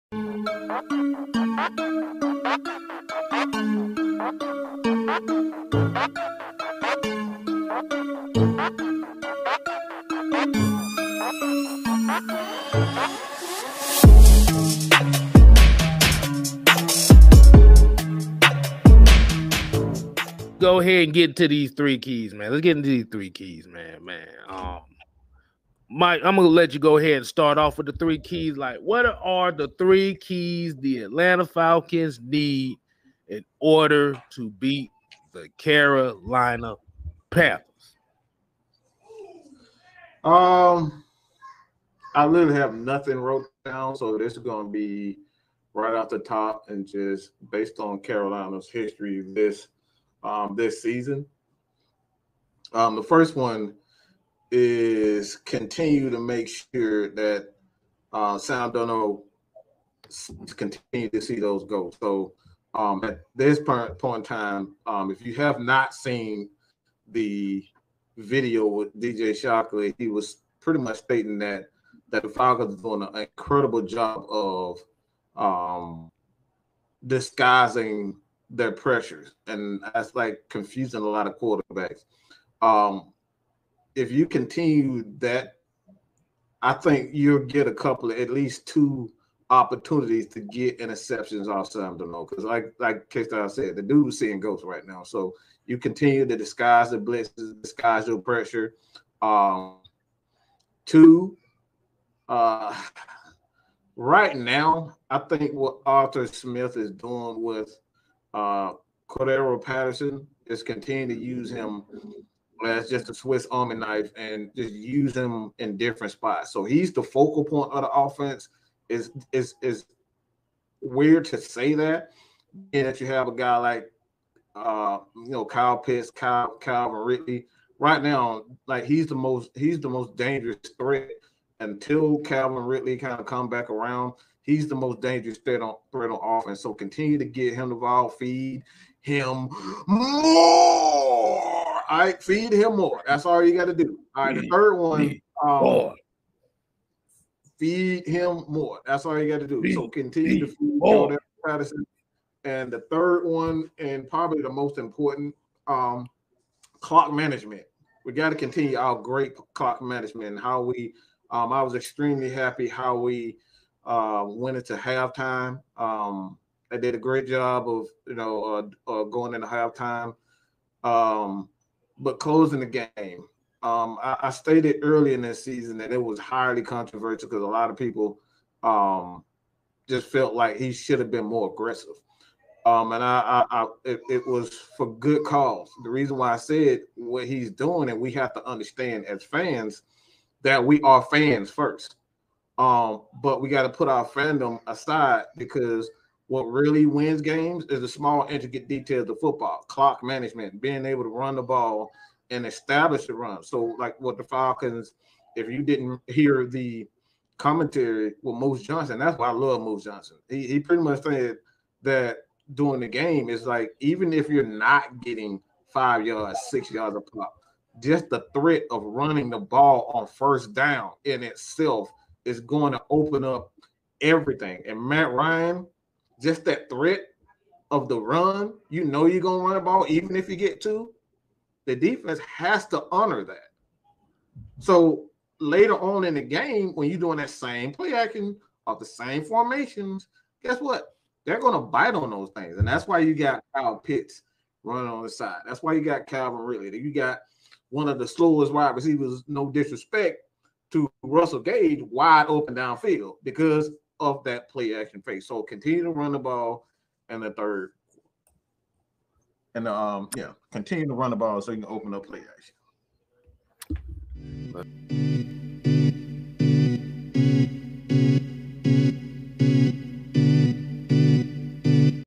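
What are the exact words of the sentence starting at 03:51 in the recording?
The defense has to honor that.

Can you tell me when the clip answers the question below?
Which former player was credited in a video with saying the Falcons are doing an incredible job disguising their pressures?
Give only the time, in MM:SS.
01:08.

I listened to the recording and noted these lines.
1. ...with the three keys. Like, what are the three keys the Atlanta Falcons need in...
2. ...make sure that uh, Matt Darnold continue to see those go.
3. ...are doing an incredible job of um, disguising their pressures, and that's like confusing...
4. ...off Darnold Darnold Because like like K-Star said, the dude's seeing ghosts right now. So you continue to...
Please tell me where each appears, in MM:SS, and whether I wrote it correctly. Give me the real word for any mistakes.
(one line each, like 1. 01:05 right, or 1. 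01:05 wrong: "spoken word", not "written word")
1. 00:27 right
2. 00:56 wrong: "Sam", not "Matt"
3. 01:12 right
4. 01:31 wrong: "Sam", not "Darnold".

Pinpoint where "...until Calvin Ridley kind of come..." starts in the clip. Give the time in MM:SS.
02:11.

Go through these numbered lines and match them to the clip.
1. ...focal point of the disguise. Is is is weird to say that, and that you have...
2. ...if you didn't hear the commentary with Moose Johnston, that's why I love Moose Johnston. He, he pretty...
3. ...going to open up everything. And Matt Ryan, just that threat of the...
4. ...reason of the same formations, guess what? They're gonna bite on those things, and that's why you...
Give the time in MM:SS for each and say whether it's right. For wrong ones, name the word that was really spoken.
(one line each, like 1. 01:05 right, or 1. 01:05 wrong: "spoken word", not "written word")
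1. 01:57 wrong: "offense", not "disguise"
2. 03:25 right
3. 03:42 right
4. 03:57 wrong: "action", not "reason".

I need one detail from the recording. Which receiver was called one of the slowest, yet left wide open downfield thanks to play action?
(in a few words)
Russell Gage.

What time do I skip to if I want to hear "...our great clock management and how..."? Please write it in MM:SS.
02:38.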